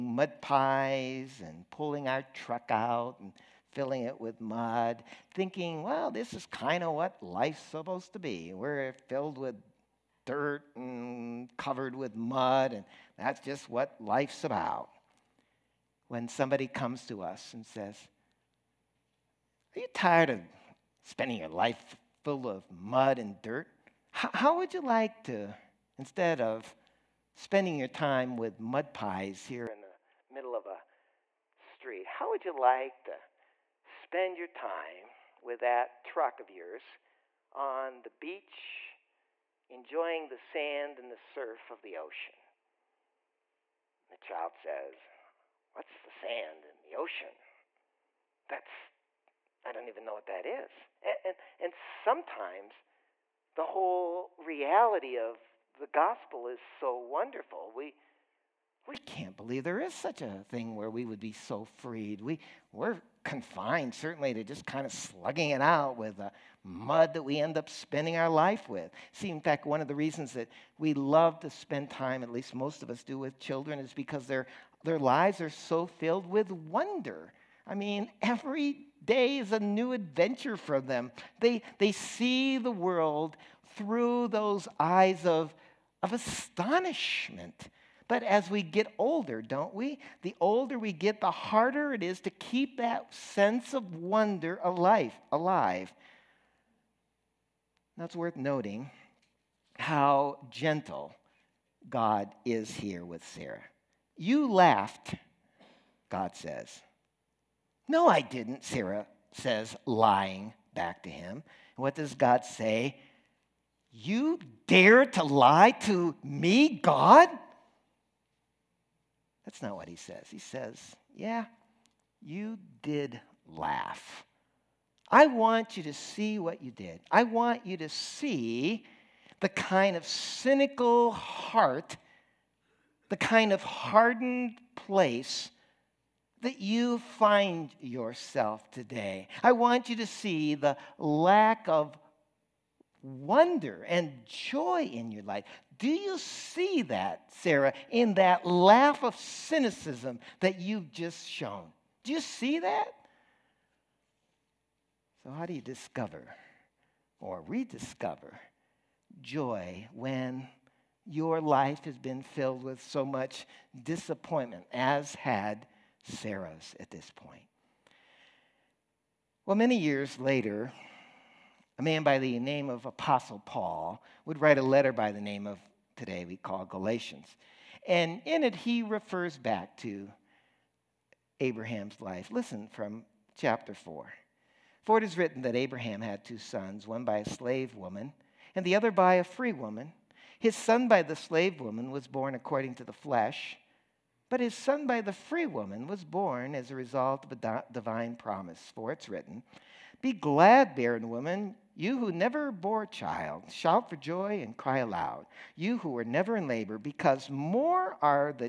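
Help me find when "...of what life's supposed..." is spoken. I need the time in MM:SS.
00:06.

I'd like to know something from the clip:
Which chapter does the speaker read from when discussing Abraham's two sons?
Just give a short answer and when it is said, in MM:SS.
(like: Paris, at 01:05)
Chapter 4, at 03:03.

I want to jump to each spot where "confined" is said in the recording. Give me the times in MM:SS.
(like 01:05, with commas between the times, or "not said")
01:03.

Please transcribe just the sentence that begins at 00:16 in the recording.
When somebody comes to us and says, Are you tired of spending your life full of mud and dirt?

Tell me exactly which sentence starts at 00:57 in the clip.
We, we can't believe there is such a thing where we would be so freed.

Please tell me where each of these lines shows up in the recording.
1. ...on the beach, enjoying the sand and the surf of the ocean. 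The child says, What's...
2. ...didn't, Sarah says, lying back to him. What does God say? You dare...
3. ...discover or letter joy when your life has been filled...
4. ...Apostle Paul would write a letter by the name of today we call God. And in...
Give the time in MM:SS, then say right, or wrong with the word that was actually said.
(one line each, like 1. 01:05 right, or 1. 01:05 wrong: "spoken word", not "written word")
1. 00:37 right
2. 01:48 right
3. 02:35 wrong: "rediscover", not "letter"
4. 02:52 wrong: "Galatians", not "God".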